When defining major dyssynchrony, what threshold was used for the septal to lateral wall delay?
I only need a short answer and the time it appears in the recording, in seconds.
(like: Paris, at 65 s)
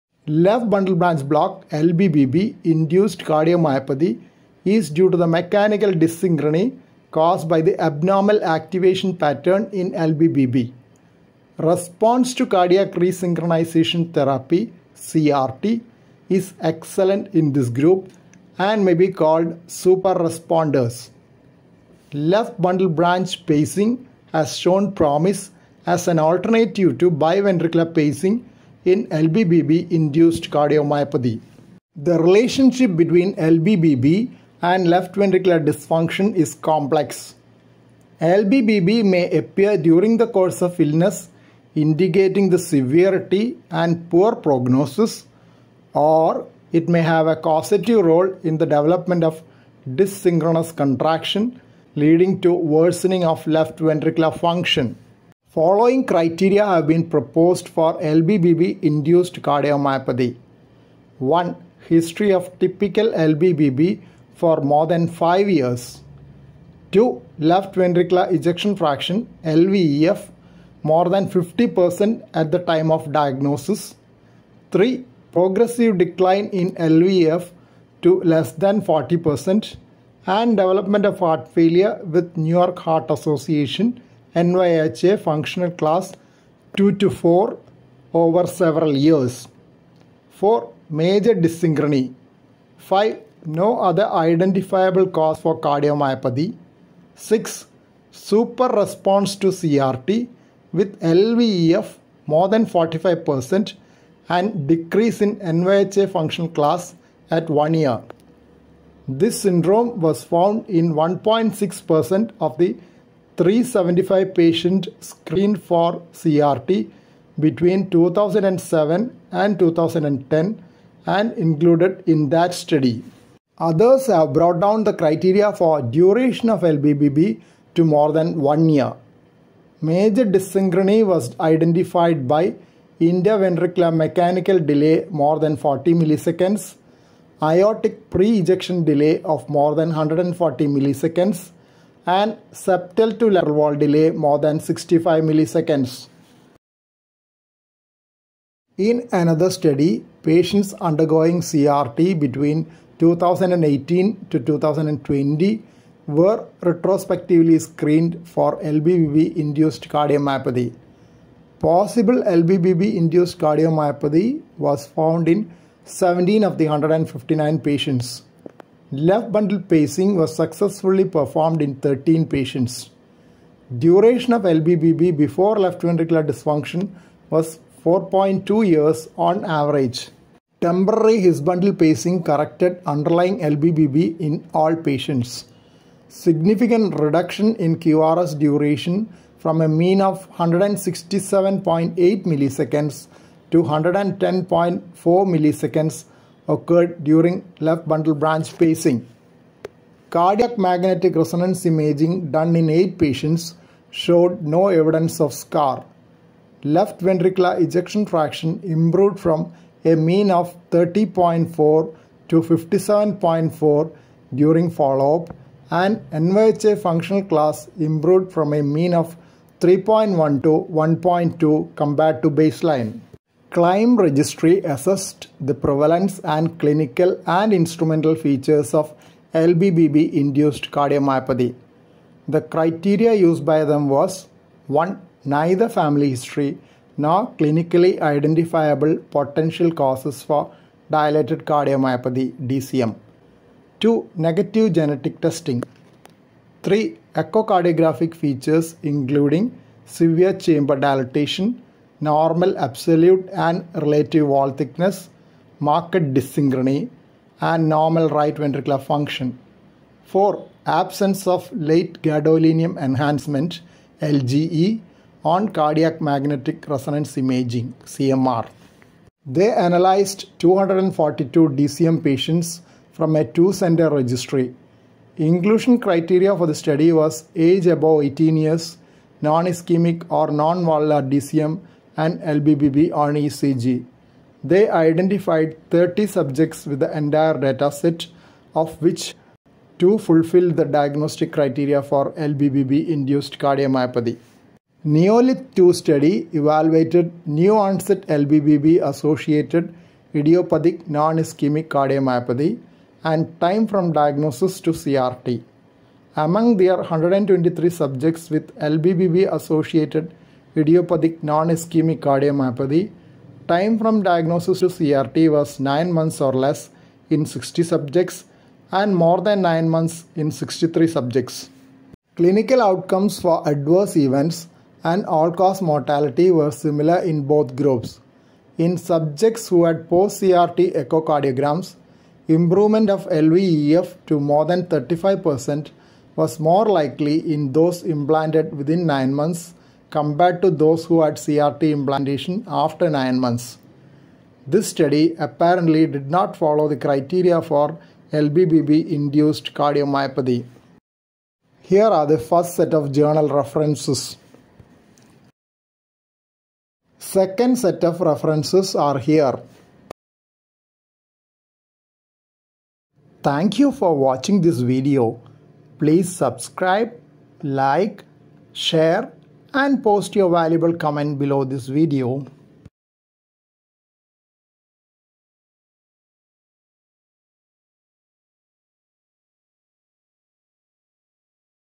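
more than 65 milliseconds, at 144 s.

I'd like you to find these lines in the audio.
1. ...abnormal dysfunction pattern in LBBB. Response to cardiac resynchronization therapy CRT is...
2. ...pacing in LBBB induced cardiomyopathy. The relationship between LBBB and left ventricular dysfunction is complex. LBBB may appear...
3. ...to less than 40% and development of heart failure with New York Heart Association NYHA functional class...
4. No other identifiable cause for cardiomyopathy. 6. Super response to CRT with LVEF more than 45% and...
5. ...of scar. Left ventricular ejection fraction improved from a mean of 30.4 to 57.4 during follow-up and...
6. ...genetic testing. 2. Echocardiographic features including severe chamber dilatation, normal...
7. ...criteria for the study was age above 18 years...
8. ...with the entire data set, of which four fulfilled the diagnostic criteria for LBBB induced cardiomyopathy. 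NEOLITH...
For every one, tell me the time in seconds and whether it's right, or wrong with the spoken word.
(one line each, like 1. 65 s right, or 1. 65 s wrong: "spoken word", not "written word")
1. 7 s wrong: "activation", not "dysfunction"
2. 27 s right
3. 78 s right
4. 93 s right
5. 205 s right
6. 244 s wrong: "3", not "2"
7. 275 s right
8. 286 s wrong: "two", not "four".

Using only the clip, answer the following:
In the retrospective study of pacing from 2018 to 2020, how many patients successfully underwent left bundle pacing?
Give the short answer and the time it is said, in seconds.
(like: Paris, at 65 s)
13, at 171 s.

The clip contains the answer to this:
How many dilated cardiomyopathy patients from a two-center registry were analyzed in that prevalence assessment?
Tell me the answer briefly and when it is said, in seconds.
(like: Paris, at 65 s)
242, at 270 s.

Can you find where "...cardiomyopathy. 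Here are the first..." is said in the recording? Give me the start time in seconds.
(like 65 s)
349 s.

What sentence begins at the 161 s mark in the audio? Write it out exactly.
Possible LBBB induced cardiomyopathy was found in 17 of the 159 patients.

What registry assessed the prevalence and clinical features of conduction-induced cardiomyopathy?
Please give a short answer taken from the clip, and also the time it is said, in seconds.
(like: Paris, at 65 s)
CLIME, at 223 s.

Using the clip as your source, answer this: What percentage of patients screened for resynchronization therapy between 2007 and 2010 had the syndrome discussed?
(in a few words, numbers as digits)
1.6%.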